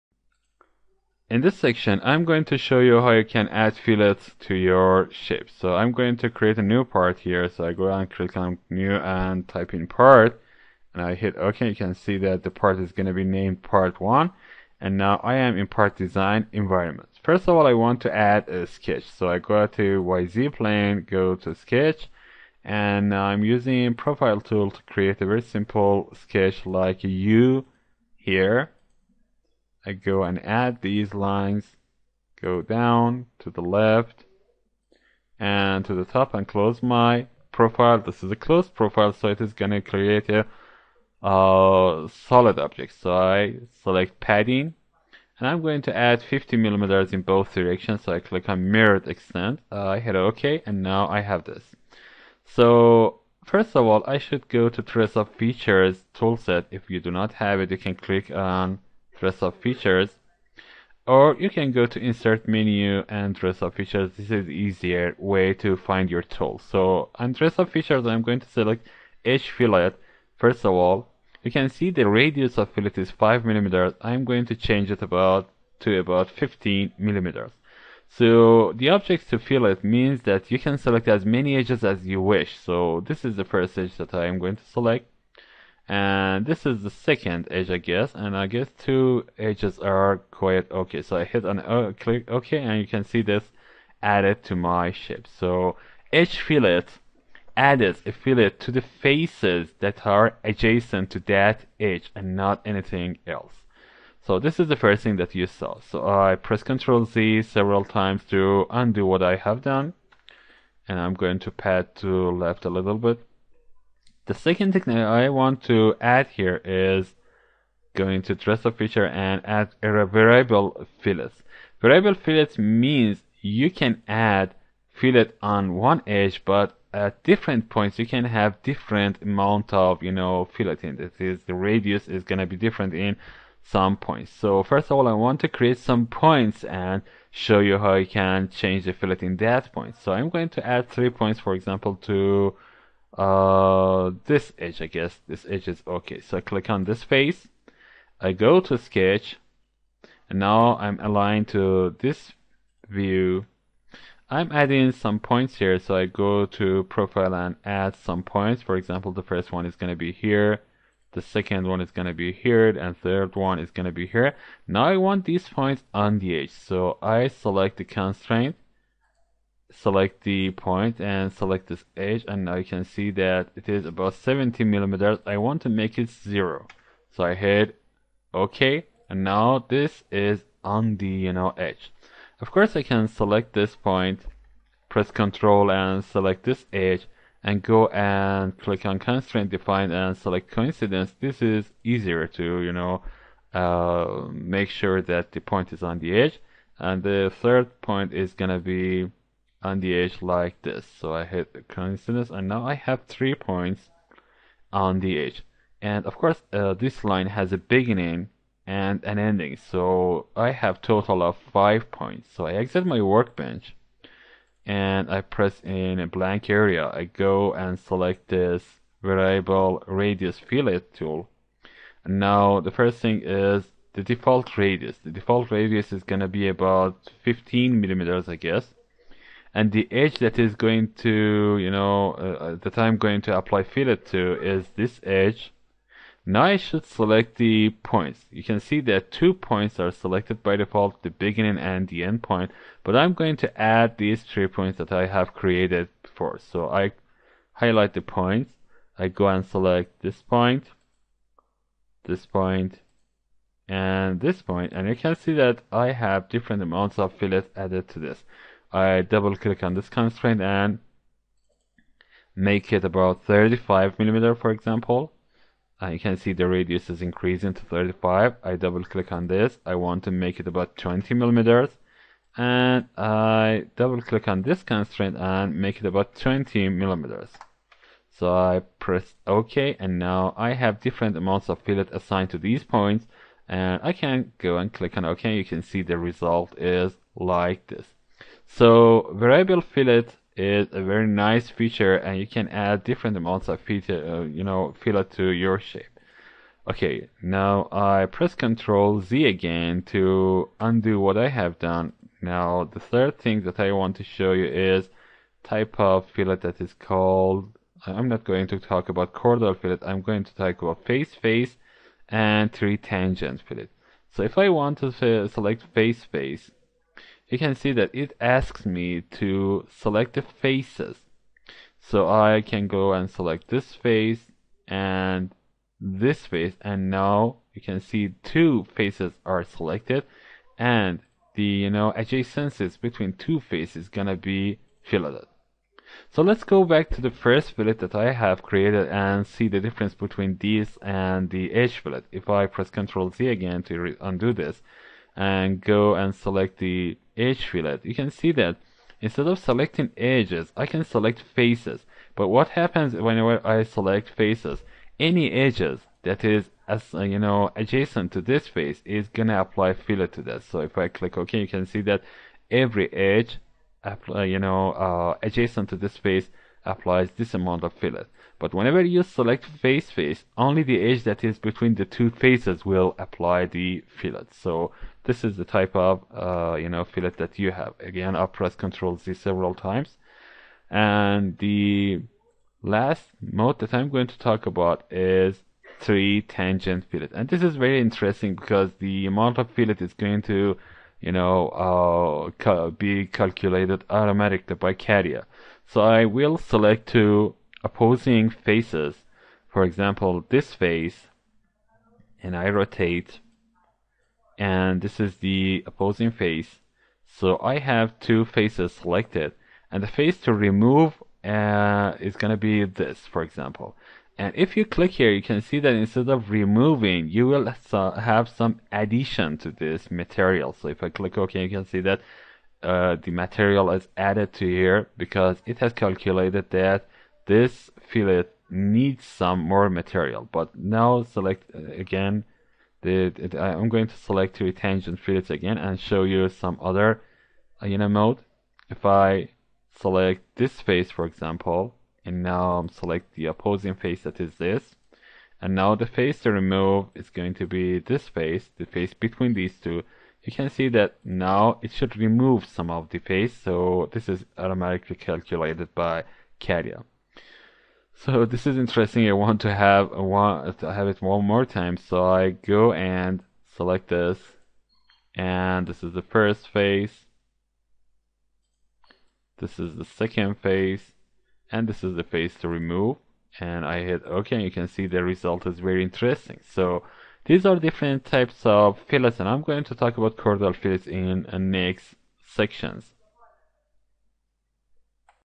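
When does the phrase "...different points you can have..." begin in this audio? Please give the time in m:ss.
2:07.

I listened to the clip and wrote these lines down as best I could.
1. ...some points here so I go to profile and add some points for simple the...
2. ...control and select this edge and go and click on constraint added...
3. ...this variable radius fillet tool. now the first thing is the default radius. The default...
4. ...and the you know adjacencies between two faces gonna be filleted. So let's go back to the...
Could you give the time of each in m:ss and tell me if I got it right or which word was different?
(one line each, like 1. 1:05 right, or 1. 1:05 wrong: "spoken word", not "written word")
1. 2:34 wrong: "example", not "simple"
2. 3:05 wrong: "defined", not "added"
3. 3:38 right
4. 5:30 right.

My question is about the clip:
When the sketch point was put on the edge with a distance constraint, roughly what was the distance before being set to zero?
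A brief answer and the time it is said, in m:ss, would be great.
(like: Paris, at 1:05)
70 millimeters, at 2:54.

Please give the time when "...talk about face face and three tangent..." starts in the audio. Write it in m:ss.
5:10.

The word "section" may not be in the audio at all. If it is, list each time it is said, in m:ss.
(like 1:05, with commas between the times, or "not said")
0:01, 8:02.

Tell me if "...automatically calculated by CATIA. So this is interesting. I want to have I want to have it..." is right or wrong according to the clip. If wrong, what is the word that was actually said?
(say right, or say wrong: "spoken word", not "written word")
right.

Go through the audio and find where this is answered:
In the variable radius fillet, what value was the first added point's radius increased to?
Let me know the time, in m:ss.
4:23.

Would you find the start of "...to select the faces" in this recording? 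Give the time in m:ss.
5:19.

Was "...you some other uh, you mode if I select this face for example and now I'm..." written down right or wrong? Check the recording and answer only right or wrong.
right.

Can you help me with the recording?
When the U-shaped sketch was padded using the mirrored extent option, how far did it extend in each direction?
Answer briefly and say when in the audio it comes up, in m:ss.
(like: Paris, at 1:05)
50 millimeters, at 0:46.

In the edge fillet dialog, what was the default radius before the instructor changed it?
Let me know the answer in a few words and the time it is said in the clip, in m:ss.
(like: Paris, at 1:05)
5 millimeters, at 1:13.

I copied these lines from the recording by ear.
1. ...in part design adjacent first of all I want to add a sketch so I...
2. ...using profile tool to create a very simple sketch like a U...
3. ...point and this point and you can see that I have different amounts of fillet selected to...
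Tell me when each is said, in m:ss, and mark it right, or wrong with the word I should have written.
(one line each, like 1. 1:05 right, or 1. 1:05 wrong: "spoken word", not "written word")
1. 0:15 wrong: "environment", not "adjacent"
2. 0:23 right
3. 4:12 wrong: "added", not "selected".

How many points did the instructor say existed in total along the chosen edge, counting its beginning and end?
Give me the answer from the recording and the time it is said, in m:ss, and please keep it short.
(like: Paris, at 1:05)
5, at 3:31.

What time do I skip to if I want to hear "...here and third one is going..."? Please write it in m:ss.
2:42.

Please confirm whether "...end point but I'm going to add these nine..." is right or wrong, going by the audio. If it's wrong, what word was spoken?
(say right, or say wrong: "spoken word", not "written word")
wrong: "three", not "nine".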